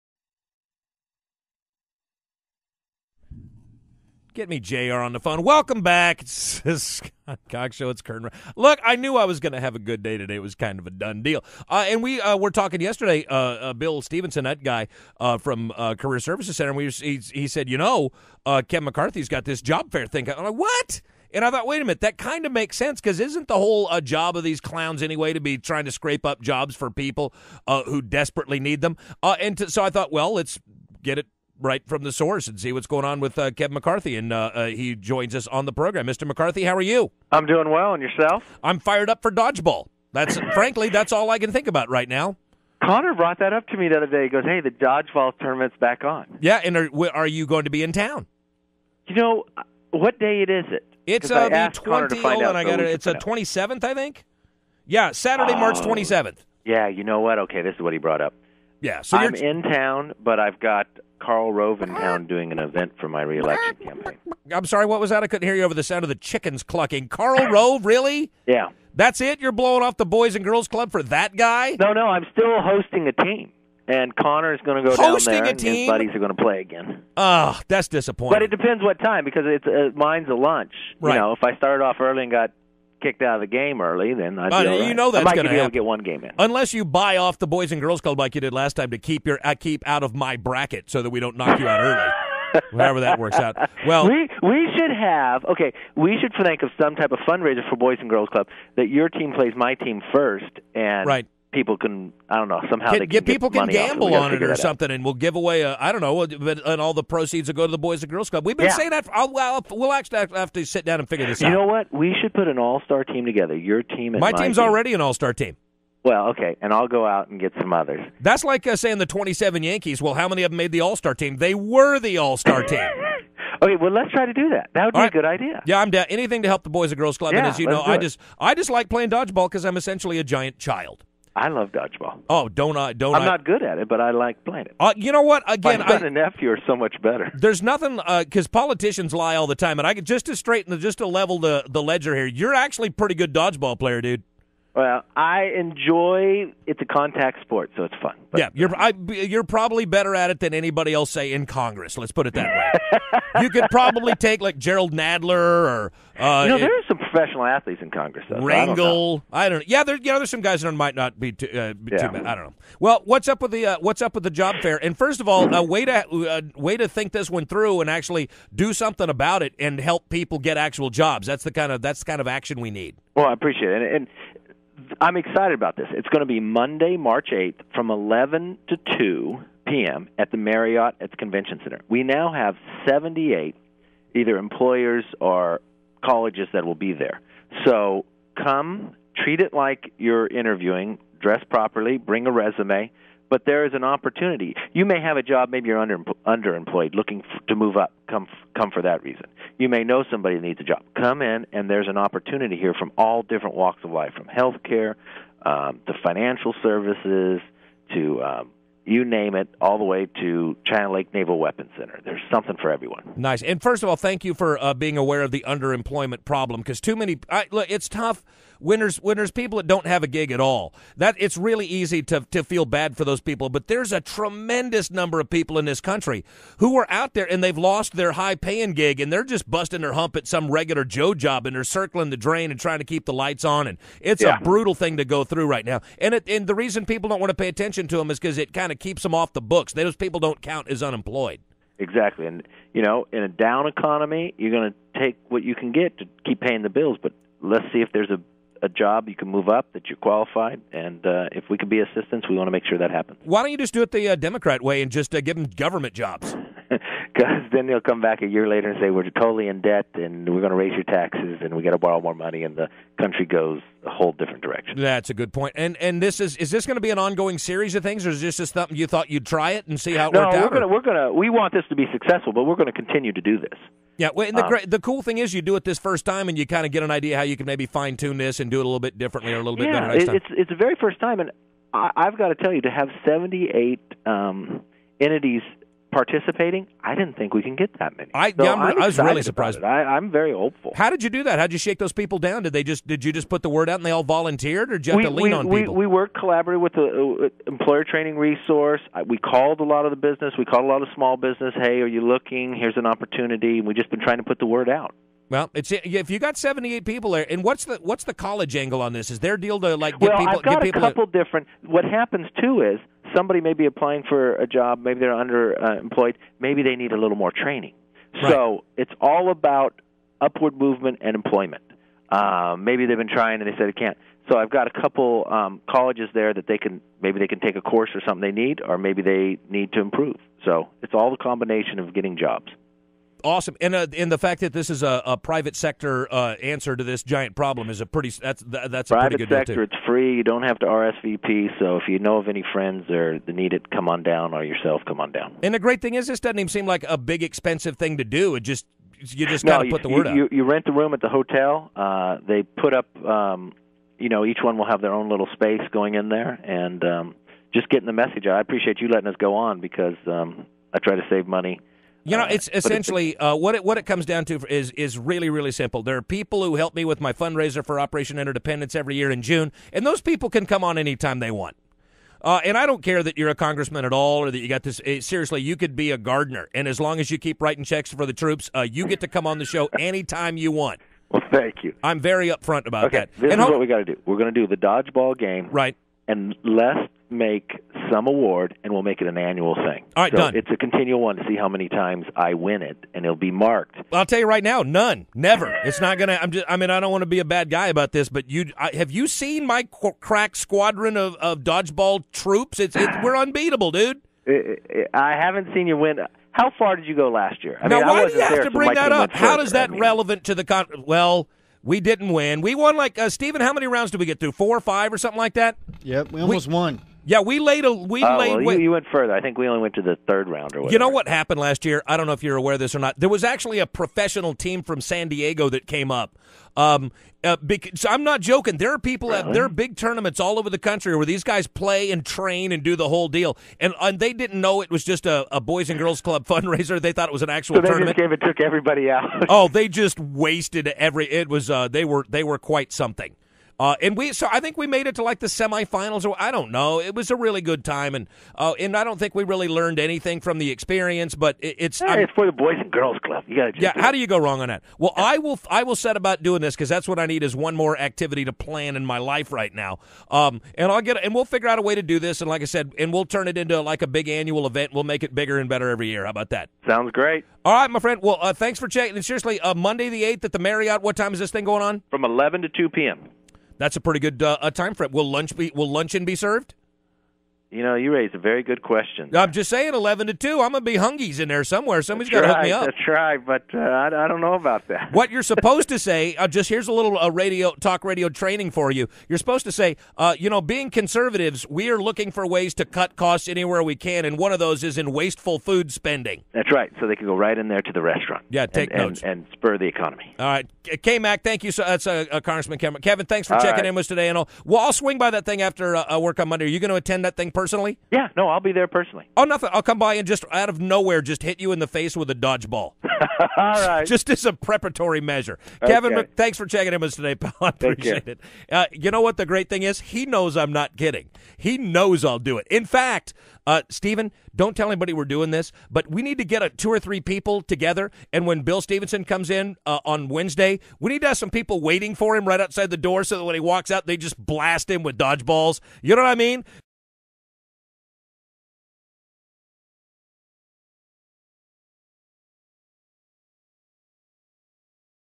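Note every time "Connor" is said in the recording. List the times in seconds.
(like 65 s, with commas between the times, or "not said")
42 s, 74 s.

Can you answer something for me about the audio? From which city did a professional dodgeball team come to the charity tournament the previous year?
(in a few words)
San Diego.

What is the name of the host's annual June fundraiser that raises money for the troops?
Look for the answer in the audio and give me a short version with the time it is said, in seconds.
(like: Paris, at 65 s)
Operation Interdependence, at 367 s.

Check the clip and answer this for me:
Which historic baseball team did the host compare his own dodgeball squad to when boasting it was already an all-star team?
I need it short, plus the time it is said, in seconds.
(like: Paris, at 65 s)
27 Yankees, at 119 s.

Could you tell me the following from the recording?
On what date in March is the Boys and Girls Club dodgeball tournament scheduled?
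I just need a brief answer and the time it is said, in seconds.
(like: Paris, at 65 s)
March 27, at 55 s.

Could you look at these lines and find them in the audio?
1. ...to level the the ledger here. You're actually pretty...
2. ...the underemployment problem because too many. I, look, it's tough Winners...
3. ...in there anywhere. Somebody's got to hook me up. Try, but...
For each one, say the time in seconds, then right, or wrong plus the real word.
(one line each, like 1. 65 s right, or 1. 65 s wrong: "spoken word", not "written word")
1. 140 s right
2. 215 s right
3. 481 s wrong: "somewhere", not "anywhere".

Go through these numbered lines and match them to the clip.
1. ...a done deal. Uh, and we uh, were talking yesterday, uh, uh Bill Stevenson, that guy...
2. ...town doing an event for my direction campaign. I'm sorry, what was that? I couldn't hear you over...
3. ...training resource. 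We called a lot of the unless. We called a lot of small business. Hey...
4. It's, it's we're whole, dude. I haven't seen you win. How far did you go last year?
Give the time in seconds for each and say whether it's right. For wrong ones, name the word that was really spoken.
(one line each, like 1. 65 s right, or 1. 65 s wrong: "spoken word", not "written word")
1. 10 s right
2. 61 s wrong: "reelection", not "direction"
3. 297 s wrong: "business", not "unless"
4. 402 s wrong: "unbeatable", not "whole".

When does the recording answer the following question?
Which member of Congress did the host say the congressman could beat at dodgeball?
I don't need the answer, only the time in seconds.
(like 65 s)
154 s.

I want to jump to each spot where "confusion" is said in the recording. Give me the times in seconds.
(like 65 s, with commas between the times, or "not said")
not said.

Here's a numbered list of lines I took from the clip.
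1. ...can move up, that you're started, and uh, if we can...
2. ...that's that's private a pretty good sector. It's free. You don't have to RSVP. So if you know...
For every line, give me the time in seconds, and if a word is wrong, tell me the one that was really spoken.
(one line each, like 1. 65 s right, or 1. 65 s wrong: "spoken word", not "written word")
1. 249 s wrong: "qualified", not "started"
2. 338 s right.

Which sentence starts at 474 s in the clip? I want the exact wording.
Will lunch be will luncheon be served?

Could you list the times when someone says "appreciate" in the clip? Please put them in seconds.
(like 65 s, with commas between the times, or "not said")
173 s, 358 s, 517 s.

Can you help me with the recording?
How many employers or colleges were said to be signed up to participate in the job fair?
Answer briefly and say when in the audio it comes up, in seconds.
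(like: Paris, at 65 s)
78, at 182 s.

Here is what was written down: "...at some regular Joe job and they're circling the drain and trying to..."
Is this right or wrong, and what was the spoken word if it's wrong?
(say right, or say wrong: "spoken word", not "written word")
right.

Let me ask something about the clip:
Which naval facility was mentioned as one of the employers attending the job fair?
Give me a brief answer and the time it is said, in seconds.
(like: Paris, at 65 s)
China Lake Naval Weapons Center, at 210 s.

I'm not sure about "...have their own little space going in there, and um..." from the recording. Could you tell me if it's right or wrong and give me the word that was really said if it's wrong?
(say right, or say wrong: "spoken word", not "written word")
right.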